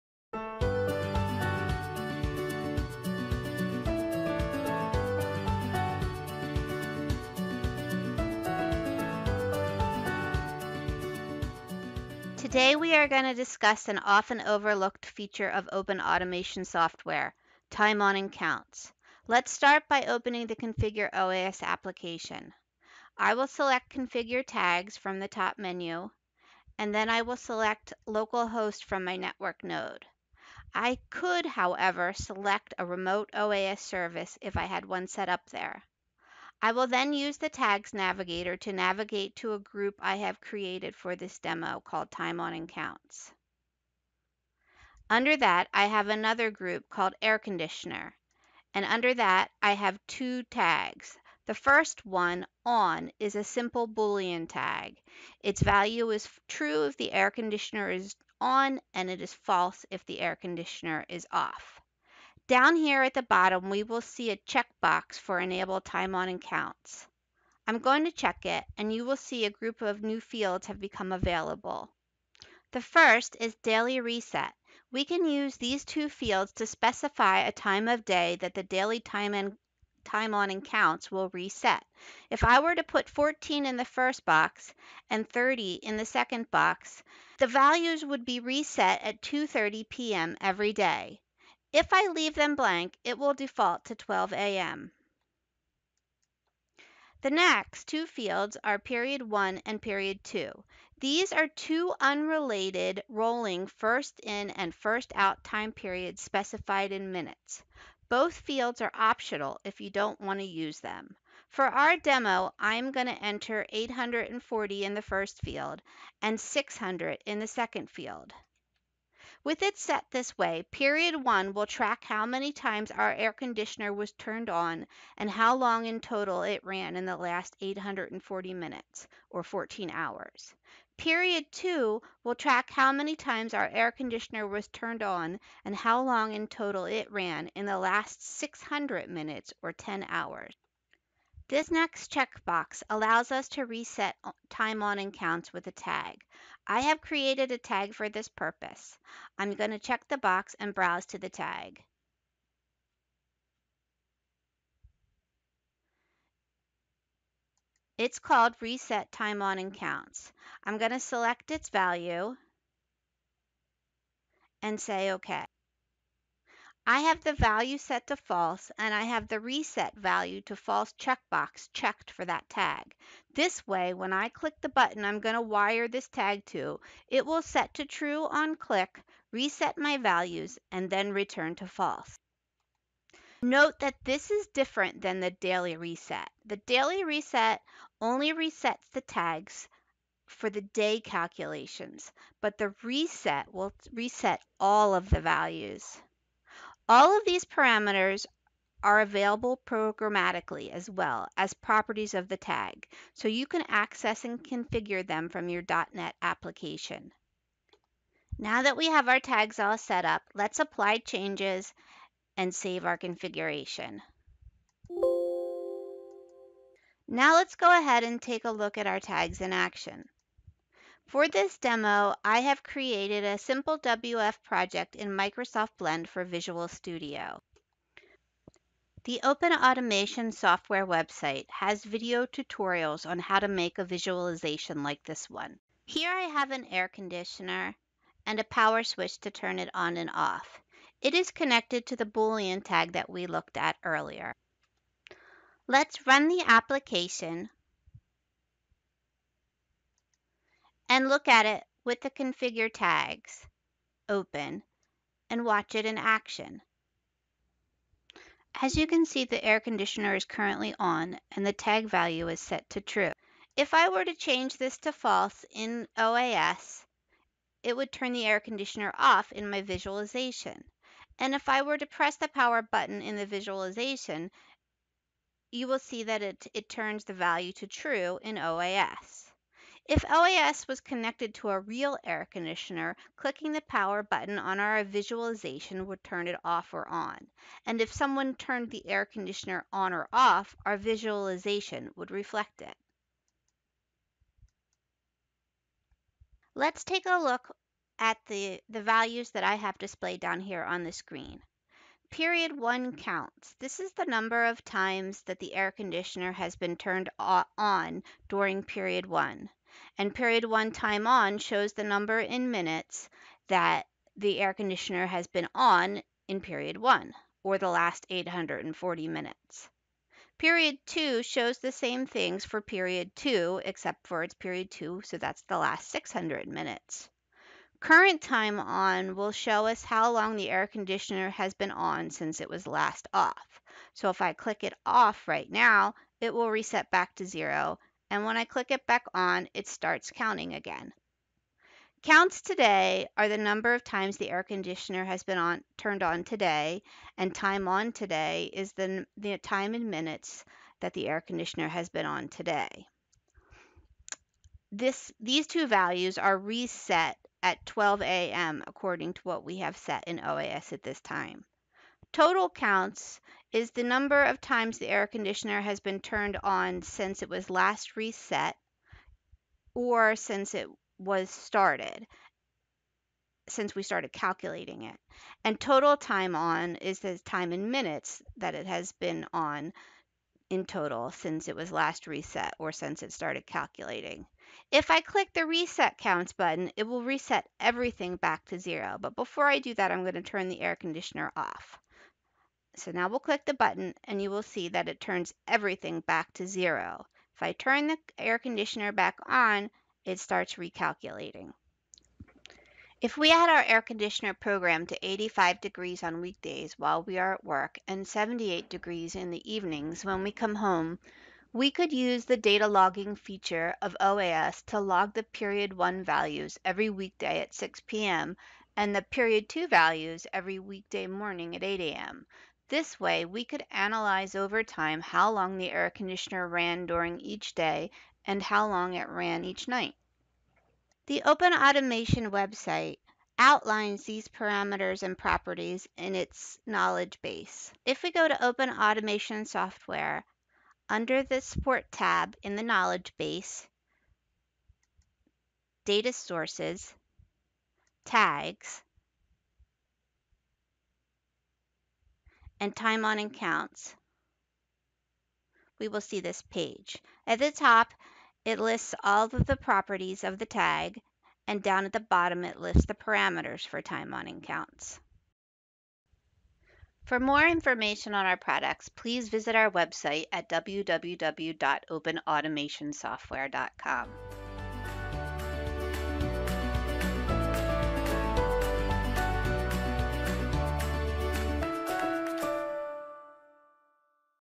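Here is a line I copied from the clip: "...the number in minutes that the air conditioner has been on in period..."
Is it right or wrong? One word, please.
right.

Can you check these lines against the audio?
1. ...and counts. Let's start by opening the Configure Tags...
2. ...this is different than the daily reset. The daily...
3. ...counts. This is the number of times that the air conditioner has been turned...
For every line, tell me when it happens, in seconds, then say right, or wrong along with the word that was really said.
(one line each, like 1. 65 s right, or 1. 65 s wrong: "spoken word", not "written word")
1. 18 s wrong: "OAS", not "Tags"
2. 184 s right
3. 302 s right.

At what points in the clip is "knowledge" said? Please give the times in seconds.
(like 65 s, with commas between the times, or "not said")
436 s, 442 s.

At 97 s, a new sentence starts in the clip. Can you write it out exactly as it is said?
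The next two fields are period 1 and period 2.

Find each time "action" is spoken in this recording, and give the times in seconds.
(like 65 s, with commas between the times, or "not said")
219 s, 255 s.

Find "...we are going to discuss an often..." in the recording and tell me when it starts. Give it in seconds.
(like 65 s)
12 s.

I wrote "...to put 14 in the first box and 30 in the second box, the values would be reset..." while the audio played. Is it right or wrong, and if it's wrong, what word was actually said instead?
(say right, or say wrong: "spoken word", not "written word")
right.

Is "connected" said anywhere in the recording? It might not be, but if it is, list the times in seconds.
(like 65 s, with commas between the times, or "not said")
241 s, 280 s.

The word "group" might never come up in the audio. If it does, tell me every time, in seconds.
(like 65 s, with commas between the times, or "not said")
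39 s, 46 s, 69 s.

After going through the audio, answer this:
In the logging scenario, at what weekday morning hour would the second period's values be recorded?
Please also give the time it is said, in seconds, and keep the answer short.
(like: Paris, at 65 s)
8 a.m., at 421 s.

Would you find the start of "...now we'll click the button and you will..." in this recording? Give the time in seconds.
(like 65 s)
392 s.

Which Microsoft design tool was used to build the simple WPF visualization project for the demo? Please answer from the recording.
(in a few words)
Microsoft Blend.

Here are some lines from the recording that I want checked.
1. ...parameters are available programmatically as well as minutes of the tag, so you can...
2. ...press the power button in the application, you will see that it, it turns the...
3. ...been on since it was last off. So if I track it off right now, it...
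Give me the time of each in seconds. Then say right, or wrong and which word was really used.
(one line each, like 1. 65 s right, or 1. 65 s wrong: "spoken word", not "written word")
1. 197 s wrong: "properties", not "minutes"
2. 271 s wrong: "visualization", not "application"
3. 331 s wrong: "click", not "track".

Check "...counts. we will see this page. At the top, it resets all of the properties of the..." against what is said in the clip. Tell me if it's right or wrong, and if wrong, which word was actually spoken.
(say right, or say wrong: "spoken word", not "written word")
wrong: "lists", not "resets".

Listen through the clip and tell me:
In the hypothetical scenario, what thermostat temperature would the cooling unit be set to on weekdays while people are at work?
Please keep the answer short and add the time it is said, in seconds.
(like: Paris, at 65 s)
85 degrees, at 405 s.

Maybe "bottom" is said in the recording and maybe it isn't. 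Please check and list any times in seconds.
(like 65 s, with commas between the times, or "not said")
63 s, 462 s.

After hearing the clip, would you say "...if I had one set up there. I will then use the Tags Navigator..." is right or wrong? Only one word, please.
right.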